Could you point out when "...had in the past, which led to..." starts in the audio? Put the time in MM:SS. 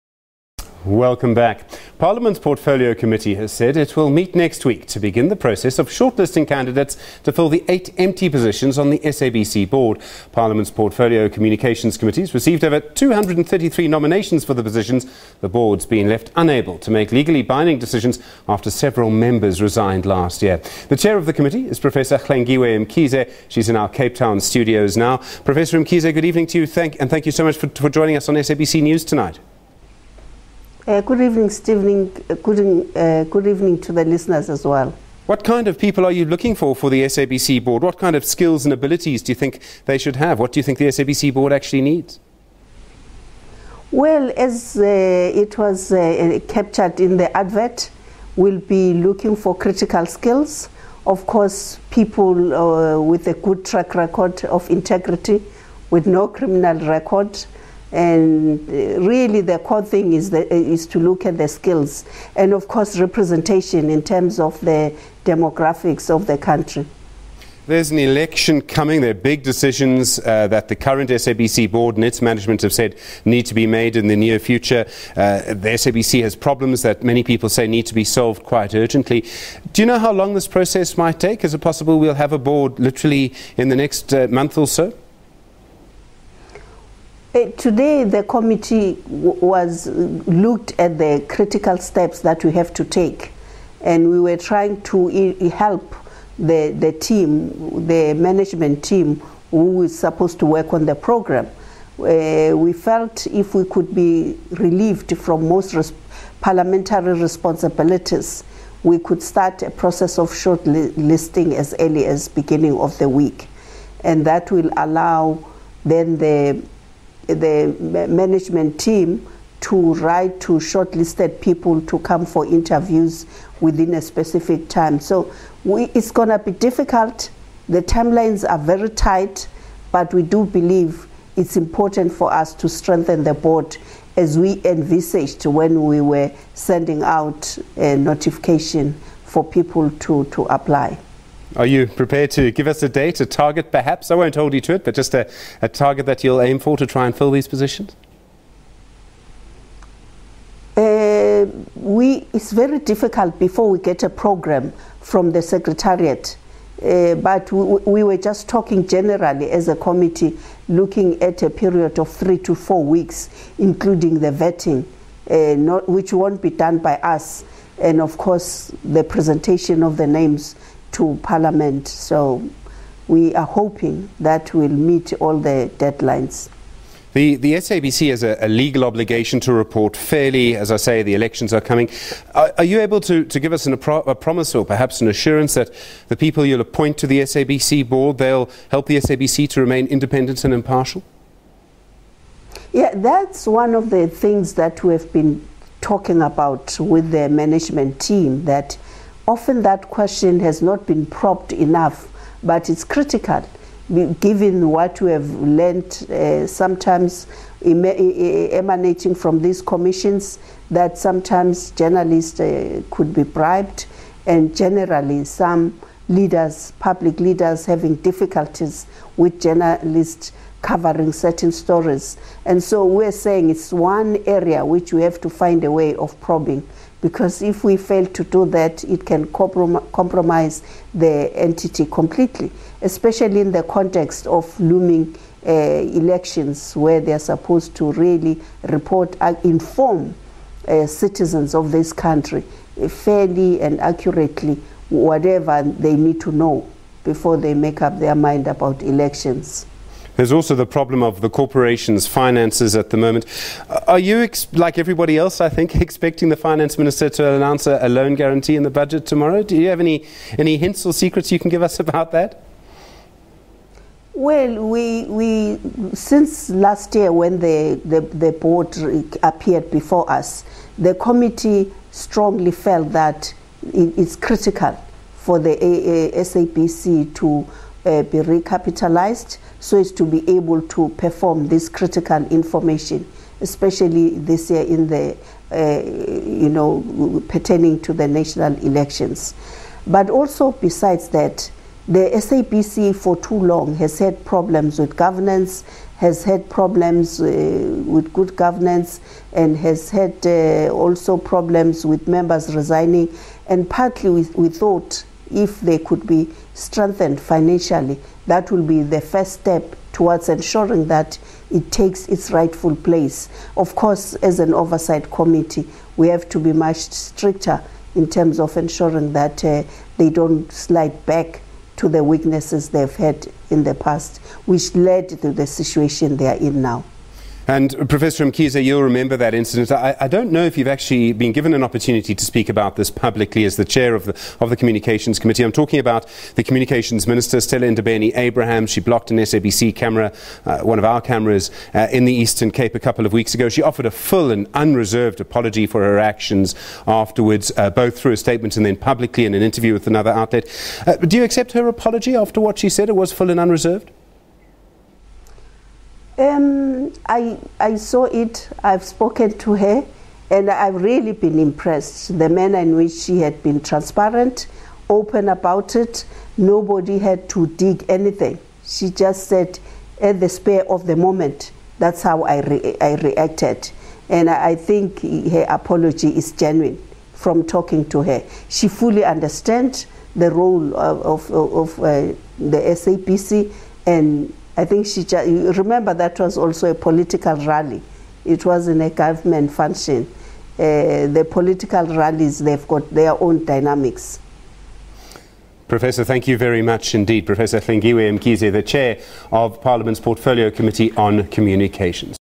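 05:22.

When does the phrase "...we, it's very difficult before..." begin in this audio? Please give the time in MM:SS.
02:31.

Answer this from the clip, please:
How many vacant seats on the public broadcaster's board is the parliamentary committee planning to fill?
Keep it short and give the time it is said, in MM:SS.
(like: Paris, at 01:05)
8, at 00:07.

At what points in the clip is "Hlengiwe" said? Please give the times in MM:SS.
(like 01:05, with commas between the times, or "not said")
00:22, 06:37.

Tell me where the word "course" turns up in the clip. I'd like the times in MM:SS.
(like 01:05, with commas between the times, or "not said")
00:51, 01:02, 02:48, 05:13.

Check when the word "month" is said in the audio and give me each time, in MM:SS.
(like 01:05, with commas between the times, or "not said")
01:24.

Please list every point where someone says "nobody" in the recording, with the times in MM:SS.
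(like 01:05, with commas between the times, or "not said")
06:06.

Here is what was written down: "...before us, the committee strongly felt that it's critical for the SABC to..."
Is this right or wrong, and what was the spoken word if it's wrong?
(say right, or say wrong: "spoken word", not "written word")
right.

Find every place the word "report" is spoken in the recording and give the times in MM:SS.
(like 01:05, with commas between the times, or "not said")
02:59, 03:58.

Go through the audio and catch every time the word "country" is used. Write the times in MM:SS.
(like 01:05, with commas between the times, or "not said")
01:06, 04:01.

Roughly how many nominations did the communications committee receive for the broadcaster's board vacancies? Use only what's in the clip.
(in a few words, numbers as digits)
233.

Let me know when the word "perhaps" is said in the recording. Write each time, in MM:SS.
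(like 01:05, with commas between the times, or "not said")
02:23, 03:04.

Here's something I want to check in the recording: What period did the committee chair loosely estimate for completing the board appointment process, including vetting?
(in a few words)
3 to 4 weeks.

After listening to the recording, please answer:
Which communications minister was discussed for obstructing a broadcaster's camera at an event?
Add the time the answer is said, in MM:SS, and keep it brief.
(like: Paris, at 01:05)
Stella Ndabeni Abraham, at 05:37.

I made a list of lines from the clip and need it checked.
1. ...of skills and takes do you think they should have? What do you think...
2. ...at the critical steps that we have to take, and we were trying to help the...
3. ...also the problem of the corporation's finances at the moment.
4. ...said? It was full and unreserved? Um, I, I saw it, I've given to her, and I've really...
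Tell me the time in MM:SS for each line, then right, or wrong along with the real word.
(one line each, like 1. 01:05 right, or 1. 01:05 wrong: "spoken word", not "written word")
1. 00:38 wrong: "abilities", not "takes"
2. 01:30 right
3. 04:10 right
4. 05:52 wrong: "spoken", not "given".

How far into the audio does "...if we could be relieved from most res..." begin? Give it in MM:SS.
01:43.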